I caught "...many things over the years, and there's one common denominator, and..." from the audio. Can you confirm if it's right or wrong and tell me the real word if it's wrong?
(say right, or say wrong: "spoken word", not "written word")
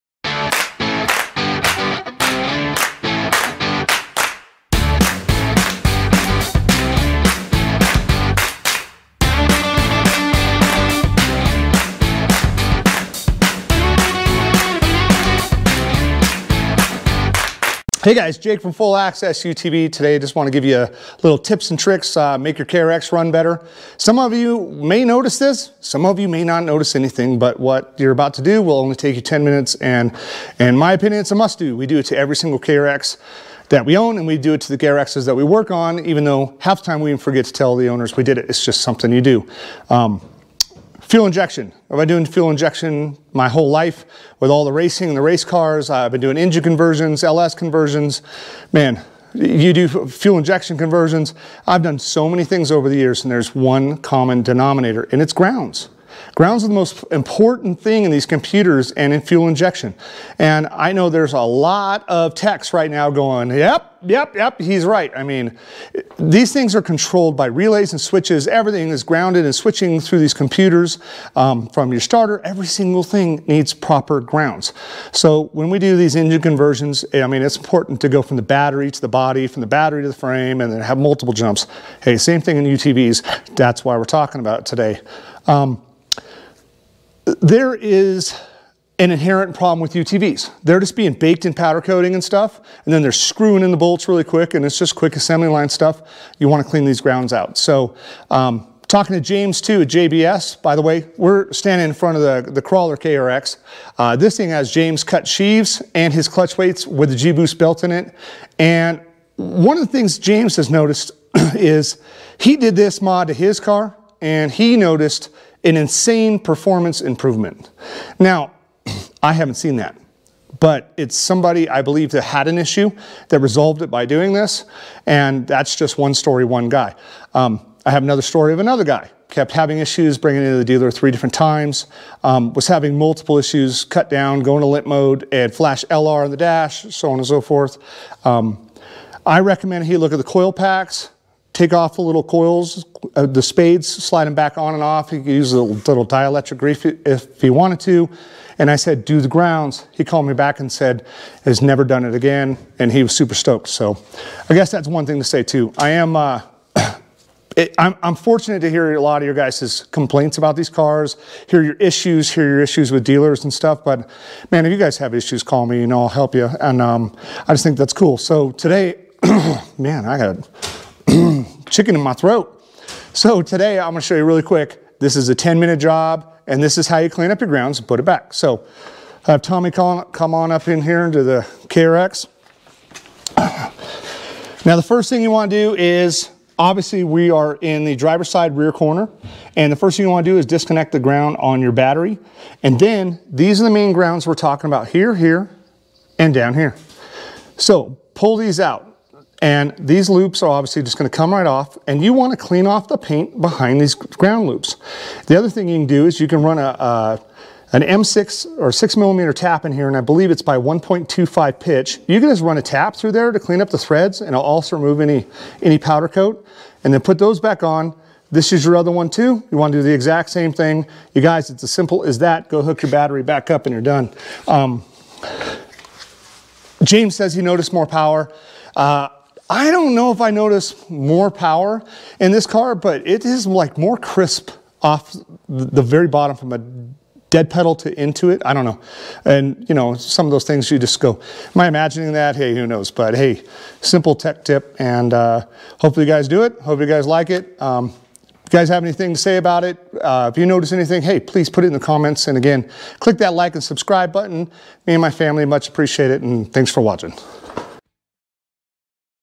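right.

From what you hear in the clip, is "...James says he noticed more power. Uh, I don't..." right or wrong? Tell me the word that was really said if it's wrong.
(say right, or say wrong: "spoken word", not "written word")
right.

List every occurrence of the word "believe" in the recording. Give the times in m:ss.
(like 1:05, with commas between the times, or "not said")
2:01, 3:30.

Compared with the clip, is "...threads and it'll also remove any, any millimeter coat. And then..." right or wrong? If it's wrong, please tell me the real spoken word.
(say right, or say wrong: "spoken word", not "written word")
wrong: "powder", not "millimeter".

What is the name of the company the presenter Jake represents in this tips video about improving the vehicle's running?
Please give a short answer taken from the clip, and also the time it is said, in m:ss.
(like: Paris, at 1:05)
Full Access UTV, at 0:18.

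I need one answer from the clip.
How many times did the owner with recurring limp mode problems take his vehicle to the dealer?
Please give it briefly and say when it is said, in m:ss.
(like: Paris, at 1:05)
3, at 2:10.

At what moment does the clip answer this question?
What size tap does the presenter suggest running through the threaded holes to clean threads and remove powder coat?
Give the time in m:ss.
3:27.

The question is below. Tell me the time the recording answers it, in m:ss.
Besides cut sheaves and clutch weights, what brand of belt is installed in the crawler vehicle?
1:47.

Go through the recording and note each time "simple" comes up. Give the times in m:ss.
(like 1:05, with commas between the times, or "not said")
3:41, 4:03.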